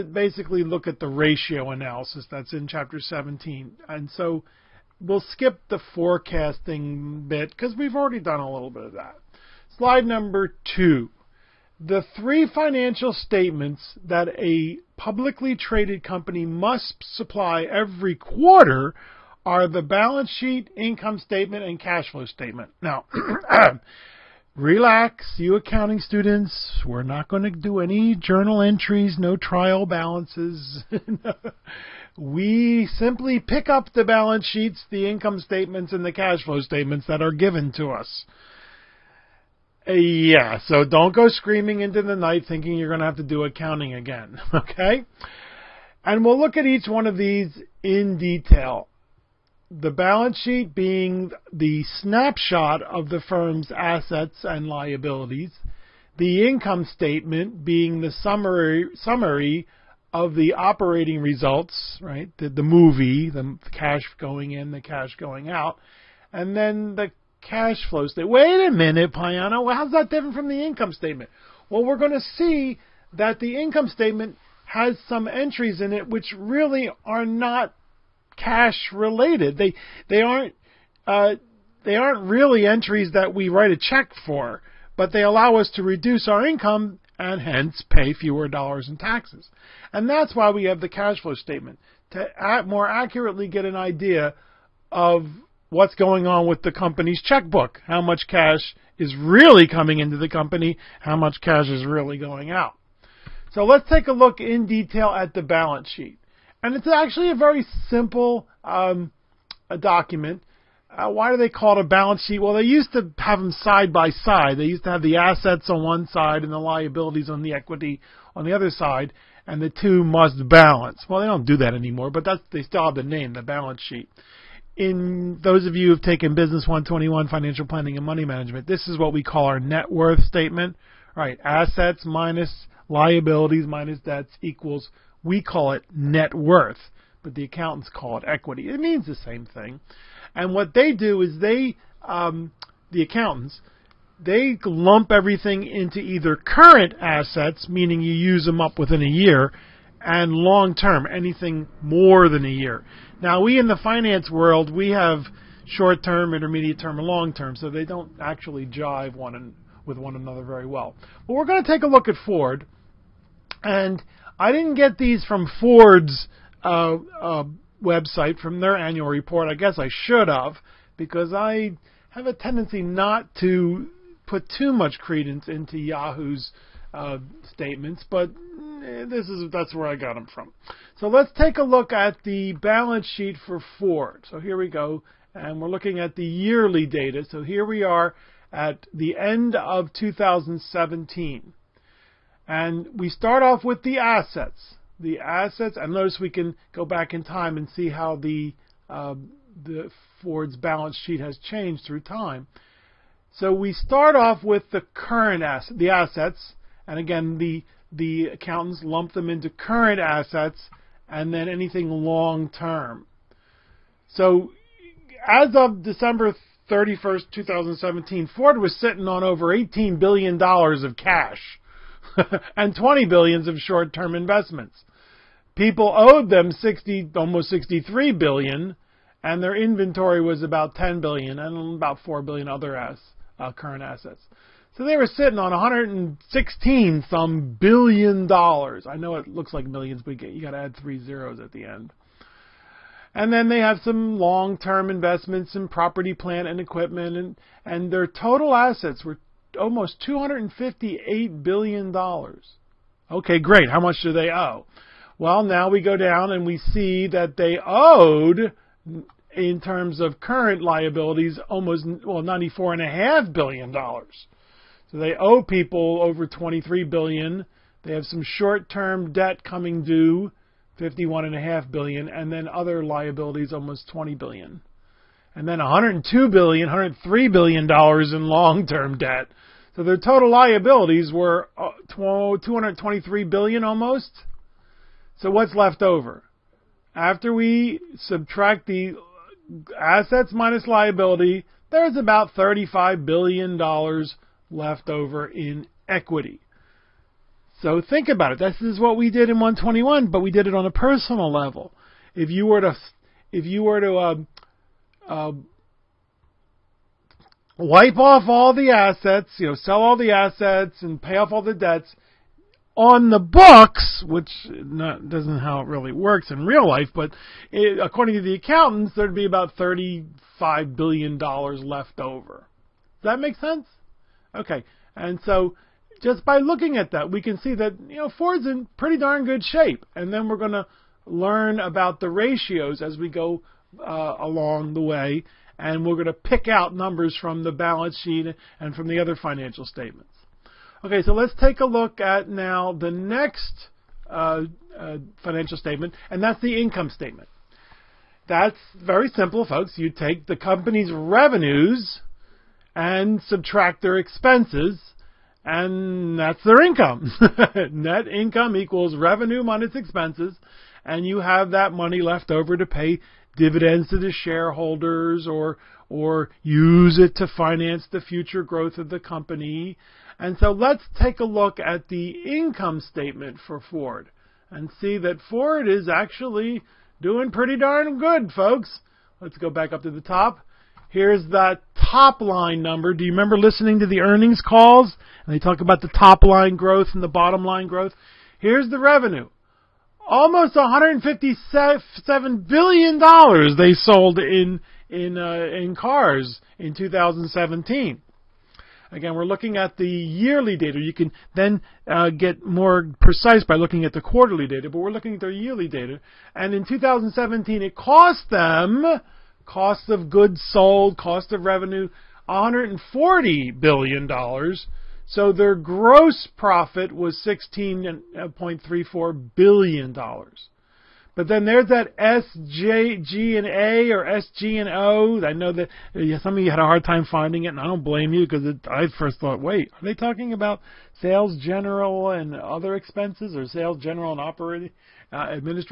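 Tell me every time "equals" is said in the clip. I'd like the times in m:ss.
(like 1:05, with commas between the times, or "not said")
2:14, 5:58.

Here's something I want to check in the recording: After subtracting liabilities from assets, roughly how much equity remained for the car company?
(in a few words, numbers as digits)
about $35 billion.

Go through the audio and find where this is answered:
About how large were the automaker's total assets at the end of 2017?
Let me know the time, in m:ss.
4:09.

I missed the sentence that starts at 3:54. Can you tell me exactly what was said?
So they were sitting on 116 some billion dollars.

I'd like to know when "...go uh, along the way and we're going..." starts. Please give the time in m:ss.
5:33.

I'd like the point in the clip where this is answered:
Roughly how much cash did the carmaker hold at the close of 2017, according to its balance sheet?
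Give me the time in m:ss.
3:39.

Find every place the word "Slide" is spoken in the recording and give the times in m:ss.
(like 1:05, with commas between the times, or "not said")
0:09.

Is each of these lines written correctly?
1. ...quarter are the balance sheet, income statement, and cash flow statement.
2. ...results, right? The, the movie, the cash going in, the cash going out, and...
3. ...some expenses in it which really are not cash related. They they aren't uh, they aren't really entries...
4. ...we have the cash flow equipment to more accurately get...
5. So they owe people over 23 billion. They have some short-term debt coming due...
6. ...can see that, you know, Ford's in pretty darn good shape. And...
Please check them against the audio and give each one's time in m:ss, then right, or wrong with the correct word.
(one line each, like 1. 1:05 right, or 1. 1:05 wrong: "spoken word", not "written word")
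1. 0:18 right
2. 1:01 right
3. 1:15 wrong: "entries", not "expenses"
4. 1:30 wrong: "statement", not "equipment"
5. 4:24 right
6. 5:27 right.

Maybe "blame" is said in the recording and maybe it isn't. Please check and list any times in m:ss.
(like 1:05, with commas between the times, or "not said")
7:07.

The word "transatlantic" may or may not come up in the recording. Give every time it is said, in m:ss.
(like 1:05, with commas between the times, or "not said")
not said.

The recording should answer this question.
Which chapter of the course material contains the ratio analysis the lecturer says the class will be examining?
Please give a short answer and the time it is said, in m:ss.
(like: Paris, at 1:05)
Chapter 17, at 0:02.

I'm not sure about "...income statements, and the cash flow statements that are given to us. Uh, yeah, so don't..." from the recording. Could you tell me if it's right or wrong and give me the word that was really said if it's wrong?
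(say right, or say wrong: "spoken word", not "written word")
right.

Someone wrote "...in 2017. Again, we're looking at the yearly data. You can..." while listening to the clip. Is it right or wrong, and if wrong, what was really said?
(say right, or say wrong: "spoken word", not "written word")
right.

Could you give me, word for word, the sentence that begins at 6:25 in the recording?
And they talk about the top line growth and the bottom line growth.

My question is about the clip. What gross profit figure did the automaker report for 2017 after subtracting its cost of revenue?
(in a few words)
$16.34 billion.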